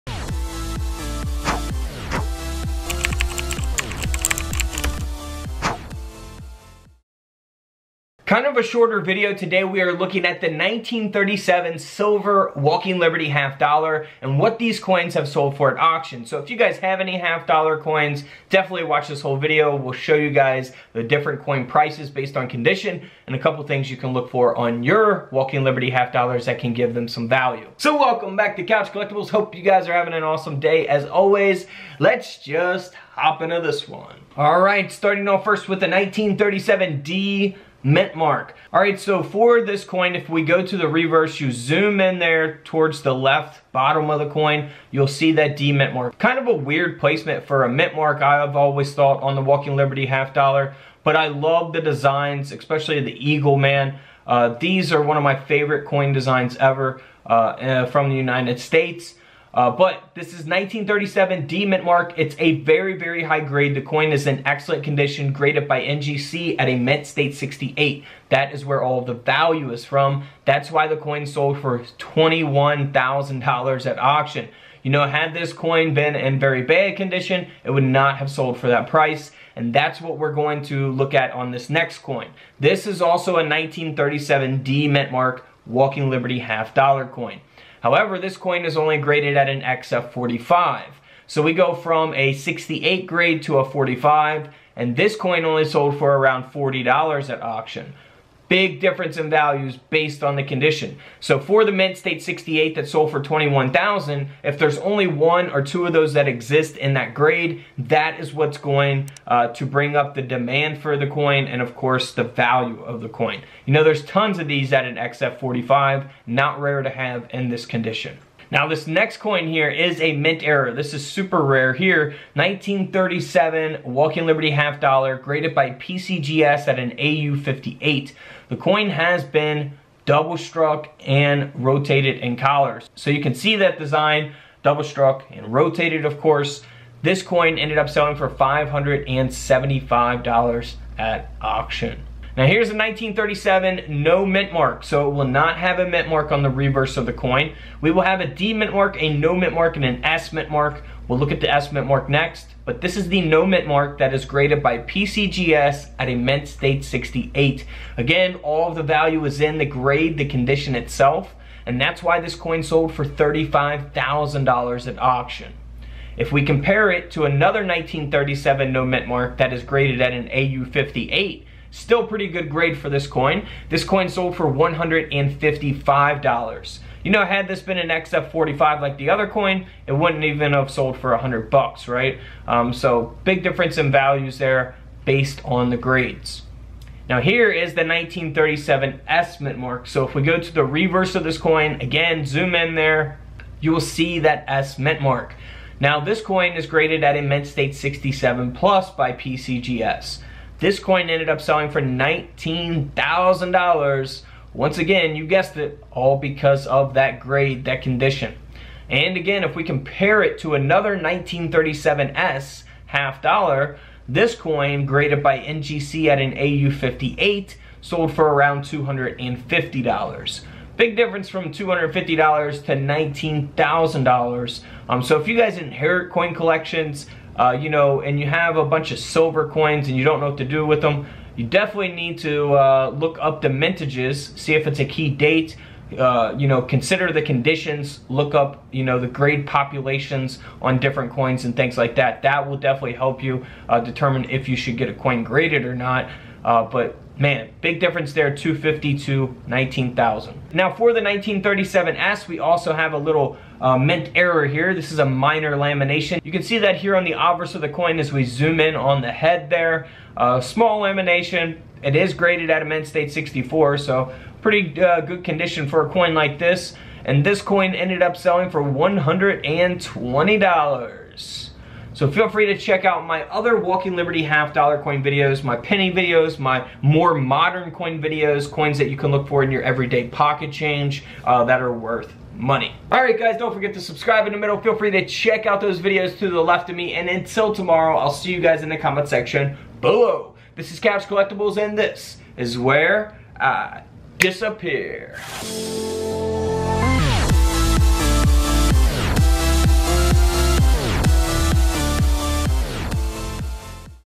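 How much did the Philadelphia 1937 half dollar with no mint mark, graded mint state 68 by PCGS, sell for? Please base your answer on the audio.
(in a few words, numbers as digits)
$35,000.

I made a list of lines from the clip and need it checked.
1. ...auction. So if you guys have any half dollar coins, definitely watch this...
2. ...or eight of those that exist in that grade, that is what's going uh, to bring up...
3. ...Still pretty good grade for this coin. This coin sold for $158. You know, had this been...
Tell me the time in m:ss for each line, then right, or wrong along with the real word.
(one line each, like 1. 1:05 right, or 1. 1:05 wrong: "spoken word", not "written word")
1. 0:15 right
2. 1:45 wrong: "two", not "eight"
3. 2:51 wrong: "155", not "158".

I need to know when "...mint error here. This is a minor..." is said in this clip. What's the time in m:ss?
4:13.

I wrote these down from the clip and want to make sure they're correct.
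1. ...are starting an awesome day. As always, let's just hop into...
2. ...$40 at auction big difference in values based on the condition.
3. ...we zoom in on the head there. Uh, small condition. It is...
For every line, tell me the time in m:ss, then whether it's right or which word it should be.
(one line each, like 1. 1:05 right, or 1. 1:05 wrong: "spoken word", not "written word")
1. 0:29 wrong: "having", not "starting"
2. 1:36 right
3. 4:18 wrong: "lamination", not "condition".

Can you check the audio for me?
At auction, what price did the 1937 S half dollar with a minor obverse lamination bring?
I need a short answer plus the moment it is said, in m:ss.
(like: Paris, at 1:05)
$120, at 4:28.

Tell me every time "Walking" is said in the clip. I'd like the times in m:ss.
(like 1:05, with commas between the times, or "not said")
0:12, 0:25, 0:49, 1:25, 2:03, 4:33.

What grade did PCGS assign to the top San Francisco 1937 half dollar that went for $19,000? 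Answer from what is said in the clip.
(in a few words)
mint state 67 plus.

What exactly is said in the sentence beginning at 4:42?
All right, guys, don't forget to subscribe in the middle.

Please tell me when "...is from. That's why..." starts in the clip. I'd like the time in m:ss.
1:09.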